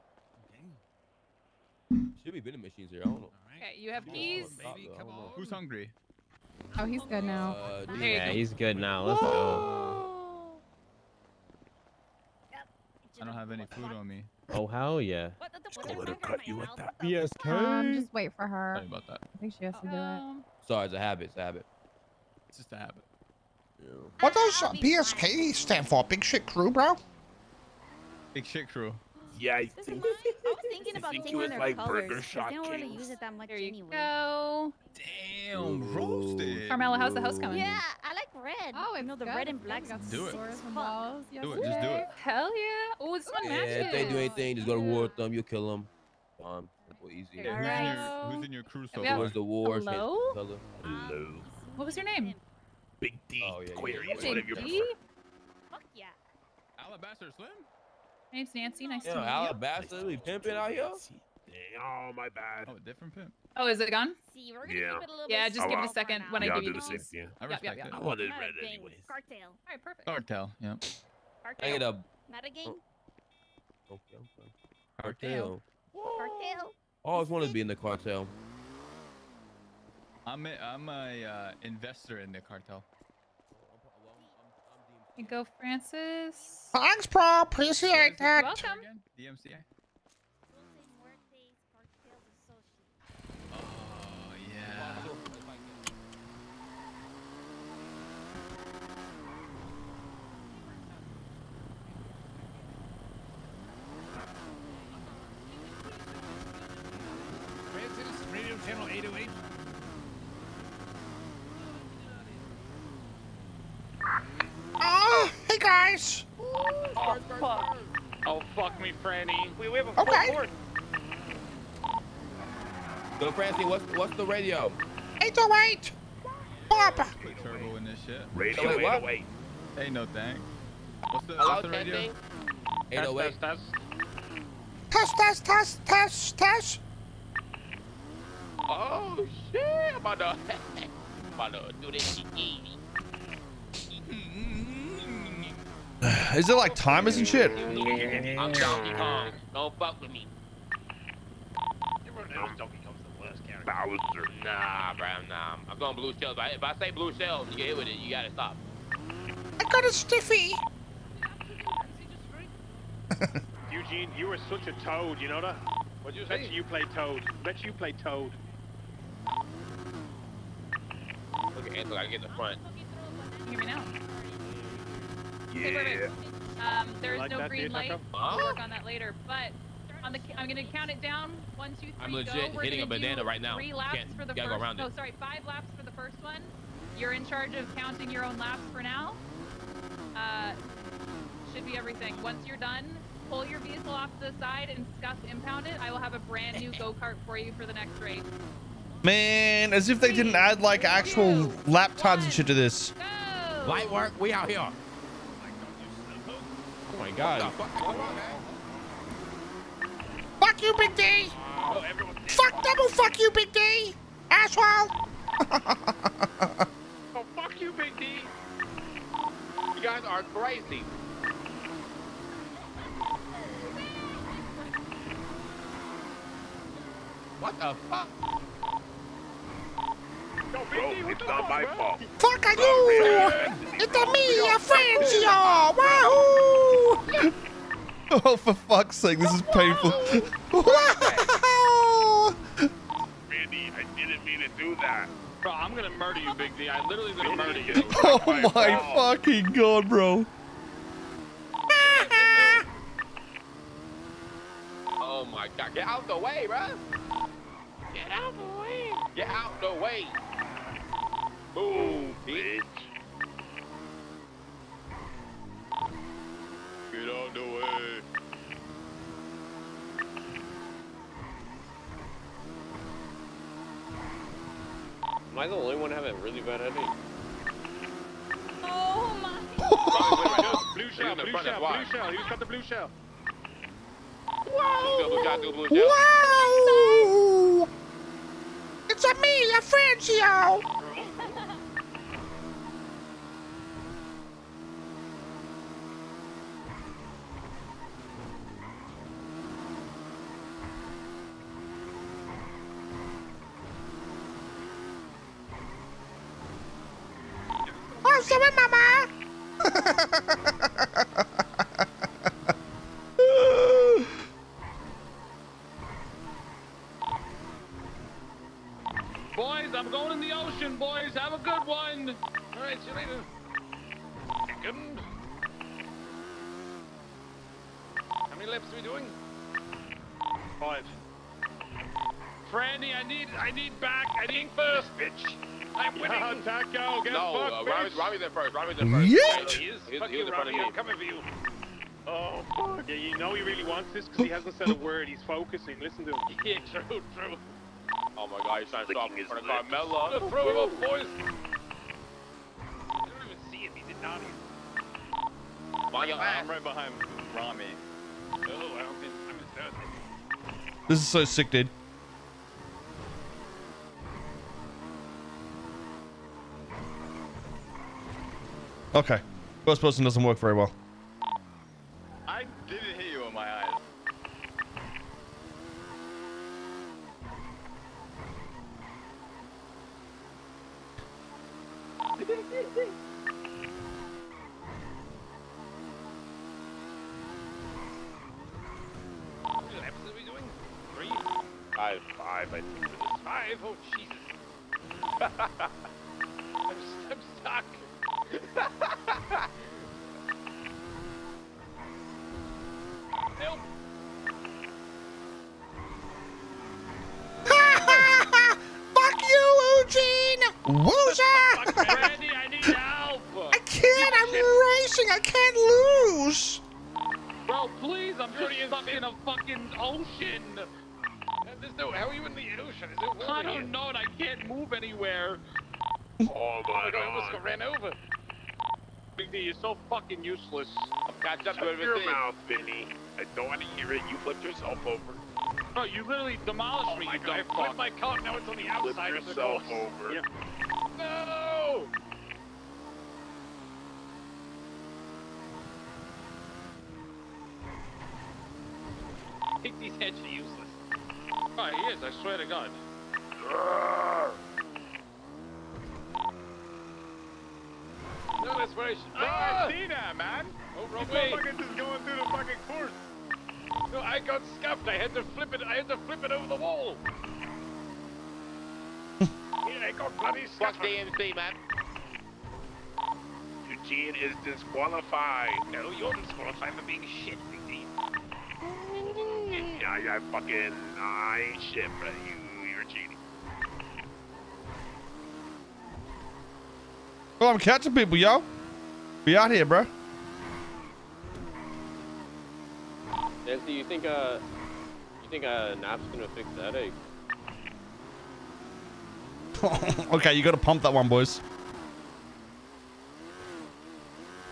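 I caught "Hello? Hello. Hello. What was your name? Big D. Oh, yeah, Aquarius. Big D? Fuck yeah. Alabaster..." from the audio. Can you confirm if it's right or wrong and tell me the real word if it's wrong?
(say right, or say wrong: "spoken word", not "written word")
right.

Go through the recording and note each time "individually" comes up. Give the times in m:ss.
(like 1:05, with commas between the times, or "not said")
not said.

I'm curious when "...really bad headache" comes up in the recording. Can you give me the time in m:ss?
4:36.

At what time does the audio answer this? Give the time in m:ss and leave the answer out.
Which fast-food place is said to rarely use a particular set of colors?
0:32.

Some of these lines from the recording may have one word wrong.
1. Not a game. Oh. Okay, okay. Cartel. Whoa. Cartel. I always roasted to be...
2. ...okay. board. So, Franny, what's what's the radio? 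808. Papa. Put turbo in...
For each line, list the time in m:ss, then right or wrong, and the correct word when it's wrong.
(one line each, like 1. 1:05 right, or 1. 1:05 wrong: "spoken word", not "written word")
1. 1:12 wrong: "wanted", not "roasted"
2. 2:00 right.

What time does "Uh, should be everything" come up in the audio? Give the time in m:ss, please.
3:10.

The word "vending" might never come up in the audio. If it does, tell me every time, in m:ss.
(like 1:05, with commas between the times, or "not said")
0:02.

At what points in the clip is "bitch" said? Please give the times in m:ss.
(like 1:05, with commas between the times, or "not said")
4:22, 5:34.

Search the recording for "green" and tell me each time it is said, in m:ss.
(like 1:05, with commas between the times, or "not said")
2:57.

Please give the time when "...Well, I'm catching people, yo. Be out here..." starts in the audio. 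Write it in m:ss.
8:07.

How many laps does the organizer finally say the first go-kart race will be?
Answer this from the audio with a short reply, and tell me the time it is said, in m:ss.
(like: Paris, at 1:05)
5, at 3:05.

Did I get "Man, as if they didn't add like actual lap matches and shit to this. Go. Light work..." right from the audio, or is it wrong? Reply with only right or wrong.
wrong.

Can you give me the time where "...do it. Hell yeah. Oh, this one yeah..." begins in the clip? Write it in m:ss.
0:41.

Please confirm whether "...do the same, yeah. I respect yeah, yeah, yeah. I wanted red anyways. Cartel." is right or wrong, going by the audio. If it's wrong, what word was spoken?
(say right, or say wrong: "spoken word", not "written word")
right.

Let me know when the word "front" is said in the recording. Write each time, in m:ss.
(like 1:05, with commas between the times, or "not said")
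2:52, 5:40, 5:49.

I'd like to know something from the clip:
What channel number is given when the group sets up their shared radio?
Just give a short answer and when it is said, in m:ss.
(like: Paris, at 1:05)
808, at 1:48.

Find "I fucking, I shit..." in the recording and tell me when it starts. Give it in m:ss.
8:00.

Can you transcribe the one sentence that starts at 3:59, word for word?
Randy, I didn't mean to do that.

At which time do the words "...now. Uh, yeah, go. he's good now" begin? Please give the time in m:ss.
0:07.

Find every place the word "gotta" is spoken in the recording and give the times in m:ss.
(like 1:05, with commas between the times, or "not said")
2:38, 8:20.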